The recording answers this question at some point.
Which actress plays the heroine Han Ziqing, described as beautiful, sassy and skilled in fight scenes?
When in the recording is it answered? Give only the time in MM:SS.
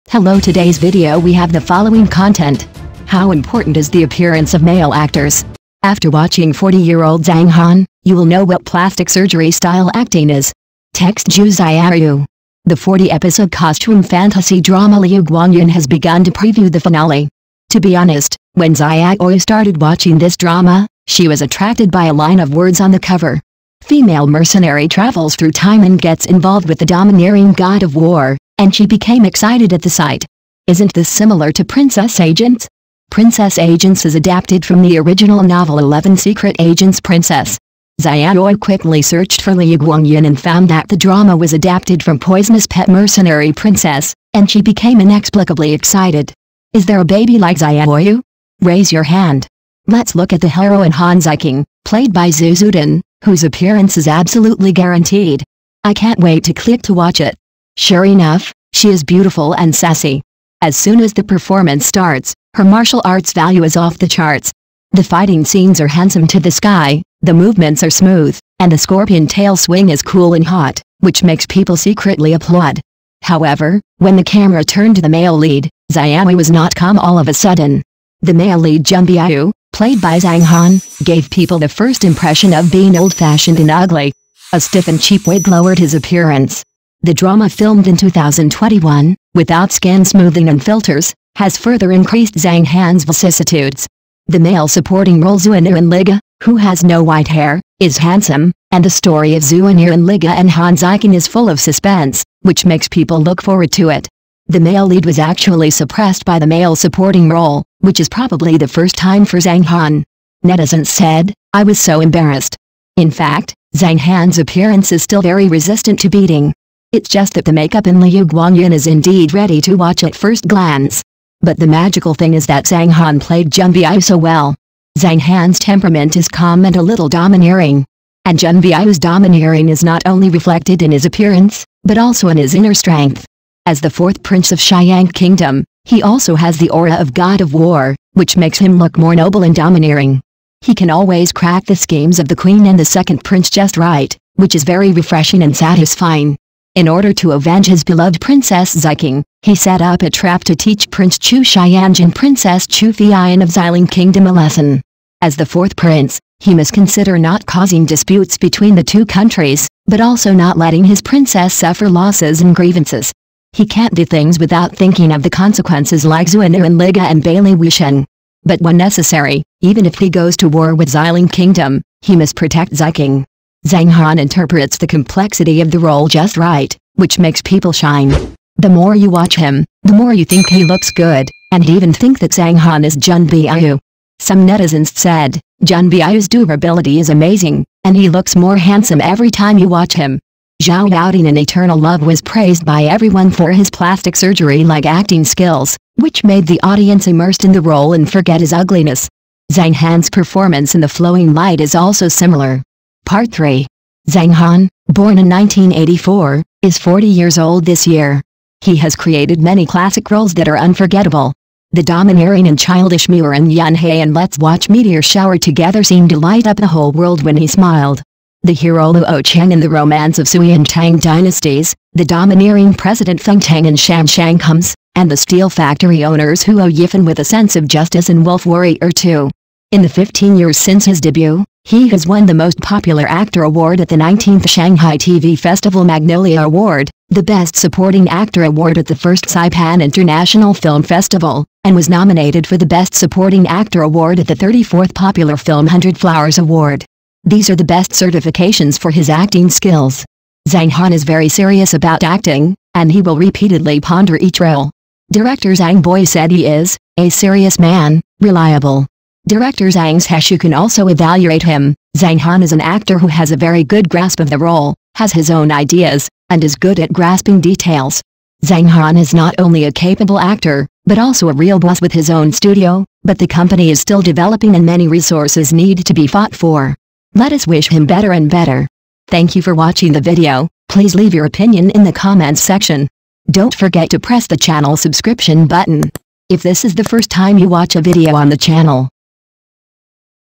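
00:52.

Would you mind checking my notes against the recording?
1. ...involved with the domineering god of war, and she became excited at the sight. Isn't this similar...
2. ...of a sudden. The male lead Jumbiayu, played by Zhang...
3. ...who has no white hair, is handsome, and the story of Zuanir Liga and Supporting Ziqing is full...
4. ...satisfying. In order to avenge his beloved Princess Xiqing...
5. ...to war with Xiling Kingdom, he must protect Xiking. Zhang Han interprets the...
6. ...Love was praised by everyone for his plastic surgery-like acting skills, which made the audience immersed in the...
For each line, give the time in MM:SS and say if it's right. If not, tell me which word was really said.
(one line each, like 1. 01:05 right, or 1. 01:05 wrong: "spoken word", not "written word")
1. 00:26 right
2. 01:17 right
3. 01:36 wrong: "Han", not "Supporting"
4. 02:25 right
5. 02:50 right
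6. 03:11 right.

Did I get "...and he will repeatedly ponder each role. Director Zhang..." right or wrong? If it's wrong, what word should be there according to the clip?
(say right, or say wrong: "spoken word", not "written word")
right.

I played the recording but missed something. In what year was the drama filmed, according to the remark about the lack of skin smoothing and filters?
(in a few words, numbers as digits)
2021.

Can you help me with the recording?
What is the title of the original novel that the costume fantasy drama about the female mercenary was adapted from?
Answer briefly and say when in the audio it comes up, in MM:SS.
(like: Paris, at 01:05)
Poisonous Pet Mercenary Princess, at 00:42.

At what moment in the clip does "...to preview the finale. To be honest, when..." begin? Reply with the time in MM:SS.
00:16.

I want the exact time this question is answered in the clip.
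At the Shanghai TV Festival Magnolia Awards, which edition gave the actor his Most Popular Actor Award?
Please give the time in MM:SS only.
03:53.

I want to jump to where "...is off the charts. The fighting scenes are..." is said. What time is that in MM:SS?
01:03.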